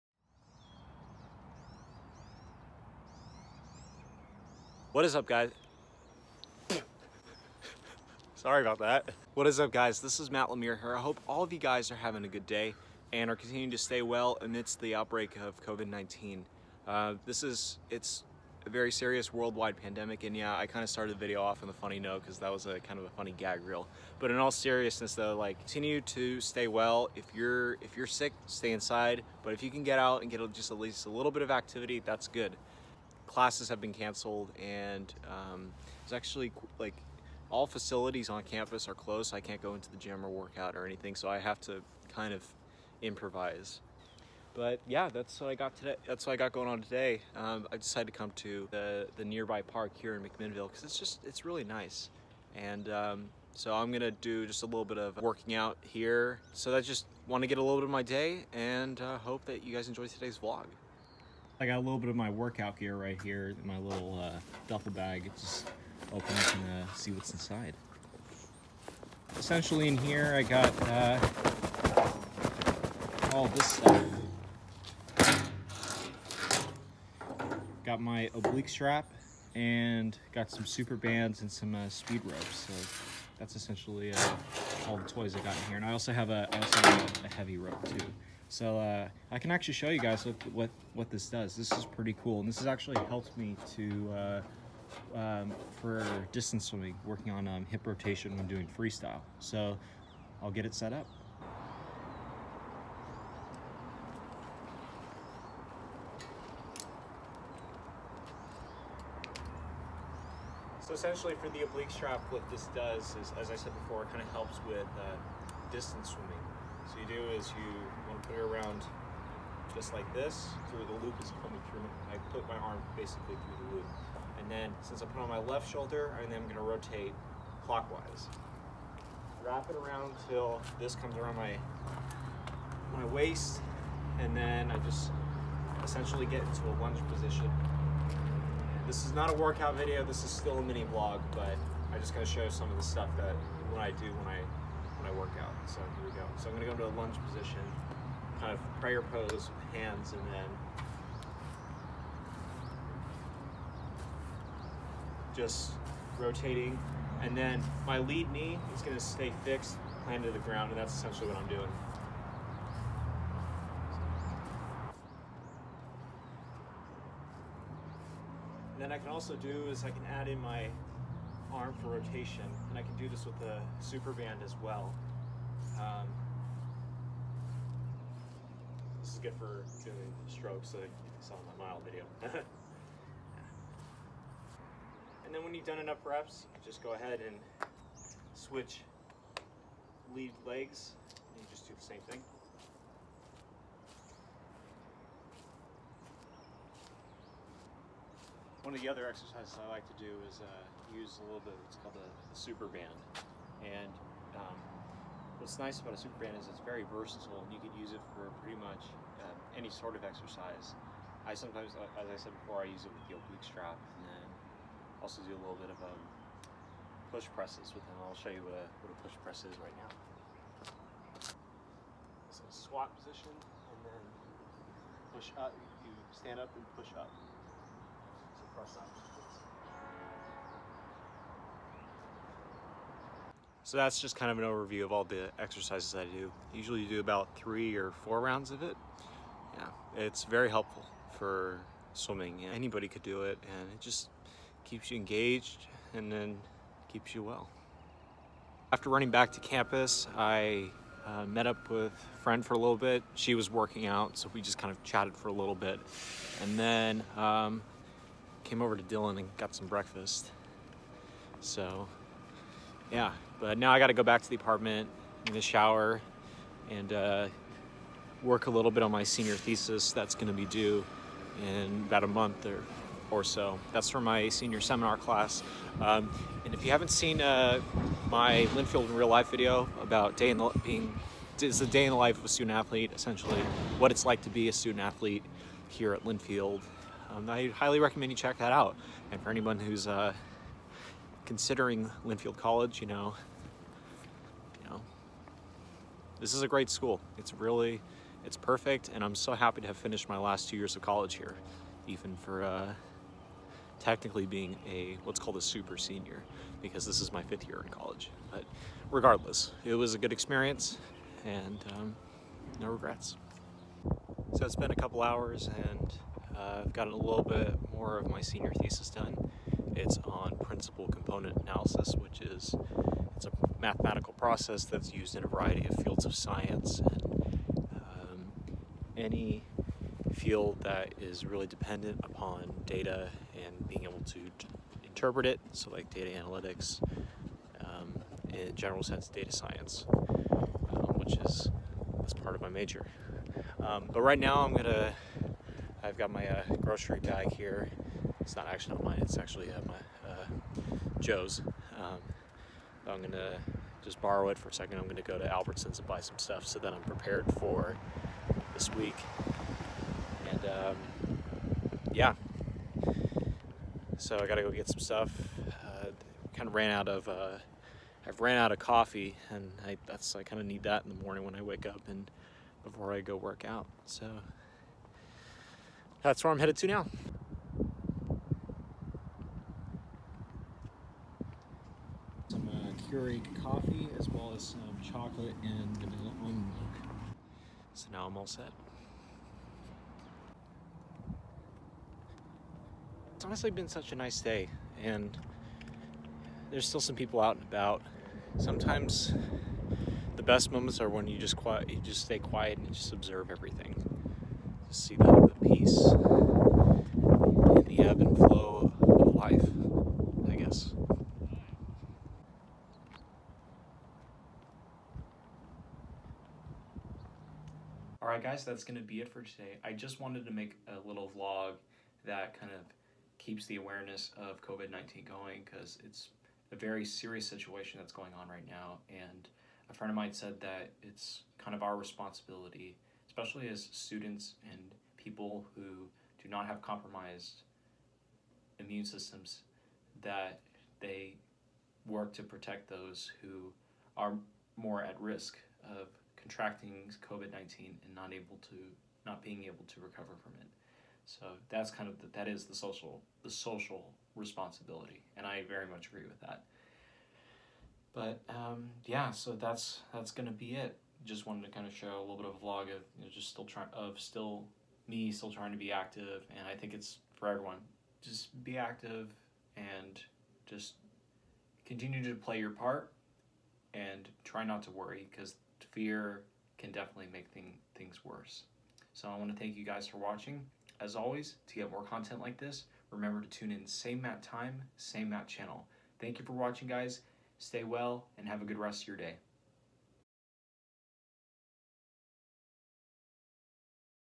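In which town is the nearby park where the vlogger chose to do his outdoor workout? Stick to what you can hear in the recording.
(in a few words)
McMinnville.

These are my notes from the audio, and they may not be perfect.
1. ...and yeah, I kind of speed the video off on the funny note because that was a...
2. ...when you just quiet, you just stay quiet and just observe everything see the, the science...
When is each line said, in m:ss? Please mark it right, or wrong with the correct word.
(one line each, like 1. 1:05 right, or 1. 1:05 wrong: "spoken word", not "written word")
1. 0:20 wrong: "started", not "speed"
2. 6:40 wrong: "peace", not "science".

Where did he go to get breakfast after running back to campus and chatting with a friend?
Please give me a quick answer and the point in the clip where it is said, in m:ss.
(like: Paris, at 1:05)
Dillin, at 4:18.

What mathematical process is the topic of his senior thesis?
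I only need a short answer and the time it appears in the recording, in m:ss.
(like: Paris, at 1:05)
principal component analysis, at 5:20.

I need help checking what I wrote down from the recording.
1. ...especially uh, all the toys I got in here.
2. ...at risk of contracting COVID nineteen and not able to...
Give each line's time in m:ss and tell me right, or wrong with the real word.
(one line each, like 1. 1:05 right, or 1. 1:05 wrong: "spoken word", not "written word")
1. 1:23 wrong: "essentially", not "especially"
2. 7:24 right.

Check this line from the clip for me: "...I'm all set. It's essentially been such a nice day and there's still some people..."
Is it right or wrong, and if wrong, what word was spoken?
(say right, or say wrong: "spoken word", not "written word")
wrong: "honestly", not "essentially".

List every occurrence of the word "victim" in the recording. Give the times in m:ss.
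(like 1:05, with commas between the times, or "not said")
not said.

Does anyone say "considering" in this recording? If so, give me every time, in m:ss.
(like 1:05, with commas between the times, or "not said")
4:51.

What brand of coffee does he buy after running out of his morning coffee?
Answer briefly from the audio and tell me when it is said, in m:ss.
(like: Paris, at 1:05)
Keurig, at 6:22.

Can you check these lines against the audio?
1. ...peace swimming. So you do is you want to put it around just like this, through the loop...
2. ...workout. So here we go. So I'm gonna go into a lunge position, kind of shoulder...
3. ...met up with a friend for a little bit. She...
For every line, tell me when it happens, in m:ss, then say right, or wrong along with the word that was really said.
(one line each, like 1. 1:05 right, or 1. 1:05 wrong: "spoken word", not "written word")
1. 1:55 wrong: "distance", not "peace"
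2. 2:25 wrong: "prayer", not "shoulder"
3. 4:11 right.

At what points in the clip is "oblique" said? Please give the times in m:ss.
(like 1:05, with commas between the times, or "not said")
1:18, 1:51, 3:33.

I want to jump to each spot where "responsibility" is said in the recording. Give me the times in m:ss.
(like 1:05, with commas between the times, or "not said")
7:11, 7:34.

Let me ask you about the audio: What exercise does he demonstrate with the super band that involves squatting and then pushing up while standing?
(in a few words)
push press.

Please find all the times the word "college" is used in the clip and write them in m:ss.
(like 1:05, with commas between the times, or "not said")
4:52, 5:00, 5:07.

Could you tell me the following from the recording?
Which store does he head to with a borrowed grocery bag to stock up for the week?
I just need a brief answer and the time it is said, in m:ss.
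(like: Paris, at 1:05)
Albertsons, at 5:55.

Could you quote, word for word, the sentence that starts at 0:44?
But yeah, that's what I got today.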